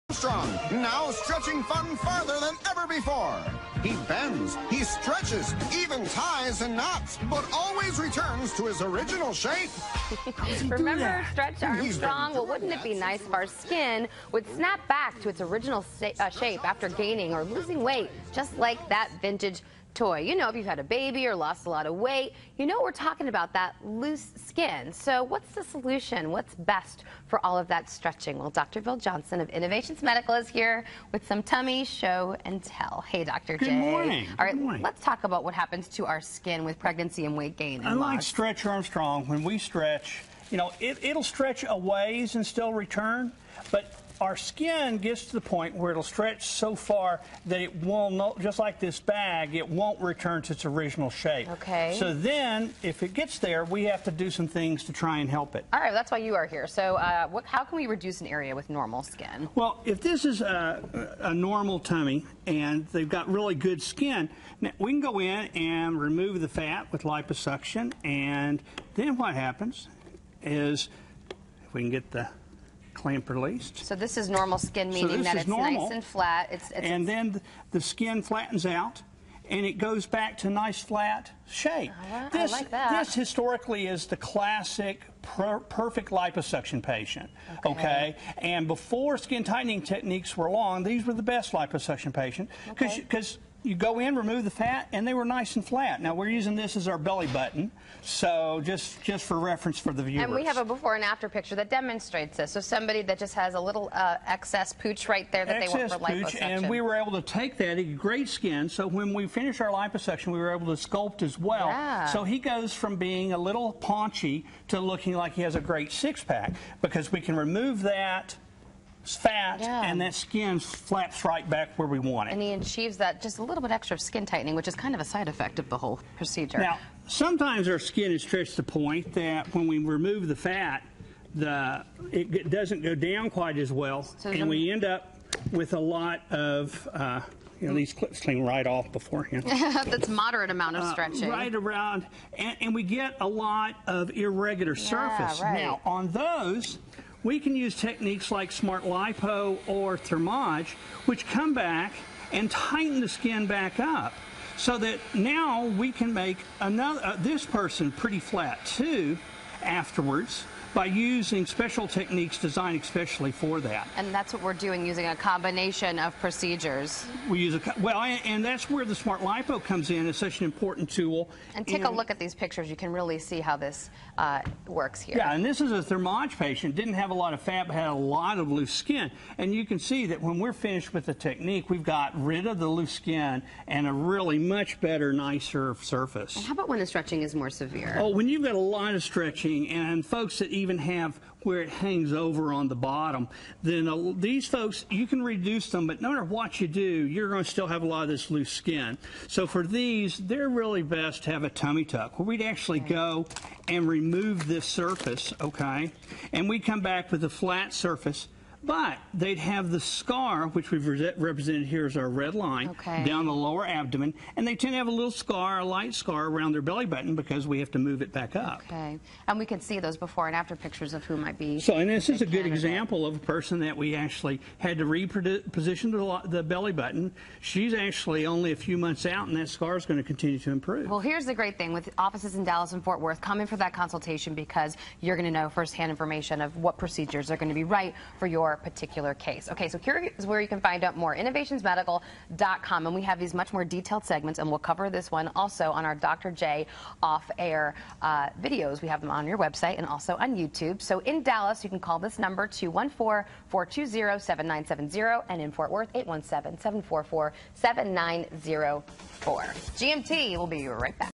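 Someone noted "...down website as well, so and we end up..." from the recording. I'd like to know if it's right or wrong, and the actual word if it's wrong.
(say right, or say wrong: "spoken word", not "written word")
wrong: "quite", not "website".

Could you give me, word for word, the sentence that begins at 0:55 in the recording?
All right, that's why you are here.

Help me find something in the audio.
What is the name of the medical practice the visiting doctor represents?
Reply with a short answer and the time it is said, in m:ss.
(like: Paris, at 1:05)
Innovations Medical, at 0:29.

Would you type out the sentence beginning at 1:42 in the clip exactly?
So somebody that just has a little uh, excess pooch right there that excess they want for pooch, liposuction.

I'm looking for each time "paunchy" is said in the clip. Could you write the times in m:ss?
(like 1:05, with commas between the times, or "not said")
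1:53.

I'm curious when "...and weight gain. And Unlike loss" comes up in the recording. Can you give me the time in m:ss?
0:37.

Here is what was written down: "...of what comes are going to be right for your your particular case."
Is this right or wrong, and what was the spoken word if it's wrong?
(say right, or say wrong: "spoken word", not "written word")
wrong: "procedures", not "comes".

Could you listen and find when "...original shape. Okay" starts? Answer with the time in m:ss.
0:50.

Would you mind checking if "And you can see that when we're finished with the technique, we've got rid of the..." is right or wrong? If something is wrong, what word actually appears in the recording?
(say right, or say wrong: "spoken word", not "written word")
right.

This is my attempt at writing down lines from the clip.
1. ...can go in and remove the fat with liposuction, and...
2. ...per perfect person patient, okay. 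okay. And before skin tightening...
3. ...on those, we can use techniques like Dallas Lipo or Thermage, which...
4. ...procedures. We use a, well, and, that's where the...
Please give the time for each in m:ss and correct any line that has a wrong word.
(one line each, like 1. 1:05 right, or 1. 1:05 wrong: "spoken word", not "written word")
1. 1:04 right
2. 1:25 wrong: "liposuction", not "person"
3. 2:25 wrong: "Smart", not "Dallas"
4. 2:46 right.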